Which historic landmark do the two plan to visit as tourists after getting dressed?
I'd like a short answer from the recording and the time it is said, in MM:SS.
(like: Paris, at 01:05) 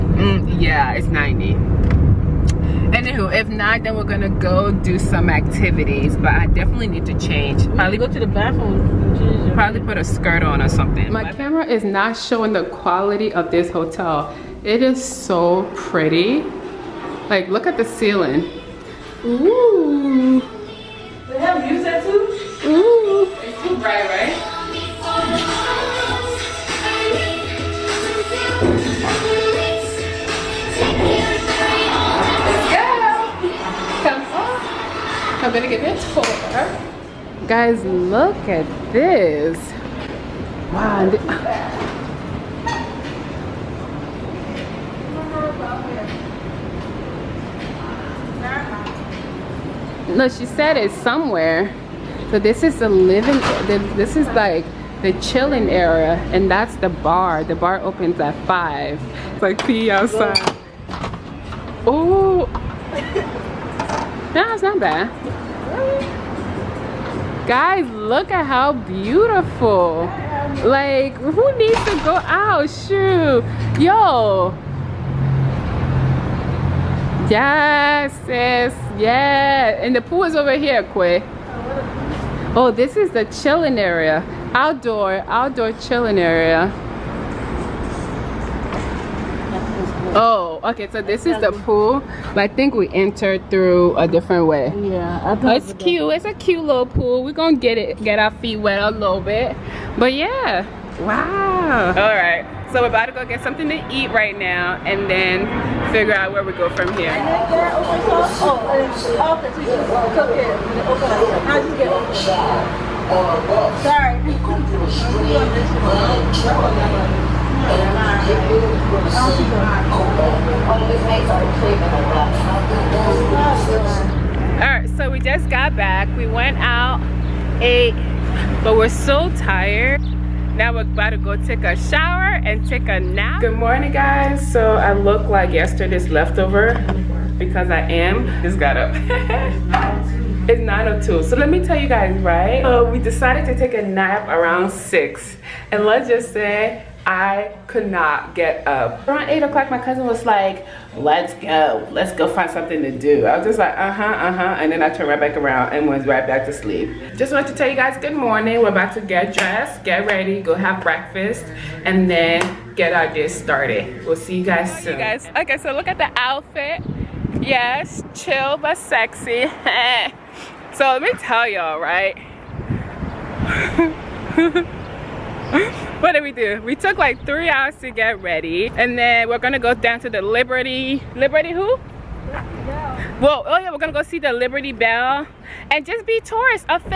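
Liberty Bell, at 03:04.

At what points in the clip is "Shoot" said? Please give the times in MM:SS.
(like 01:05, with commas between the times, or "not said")
01:12.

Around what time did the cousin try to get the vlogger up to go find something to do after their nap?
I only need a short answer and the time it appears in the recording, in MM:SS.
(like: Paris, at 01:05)
8 o'clock, at 02:29.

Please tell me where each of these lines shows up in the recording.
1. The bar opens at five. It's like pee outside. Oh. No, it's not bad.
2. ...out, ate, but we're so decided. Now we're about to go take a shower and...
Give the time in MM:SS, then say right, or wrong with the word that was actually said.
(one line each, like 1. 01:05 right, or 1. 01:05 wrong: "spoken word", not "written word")
1. 00:57 right
2. 02:06 wrong: "tired", not "decided".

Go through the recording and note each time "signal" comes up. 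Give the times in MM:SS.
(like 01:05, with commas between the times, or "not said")
not said.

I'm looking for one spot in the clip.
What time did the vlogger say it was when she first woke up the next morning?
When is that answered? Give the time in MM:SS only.
02:20.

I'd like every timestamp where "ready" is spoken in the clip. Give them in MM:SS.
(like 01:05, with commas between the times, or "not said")
02:40, 02:58.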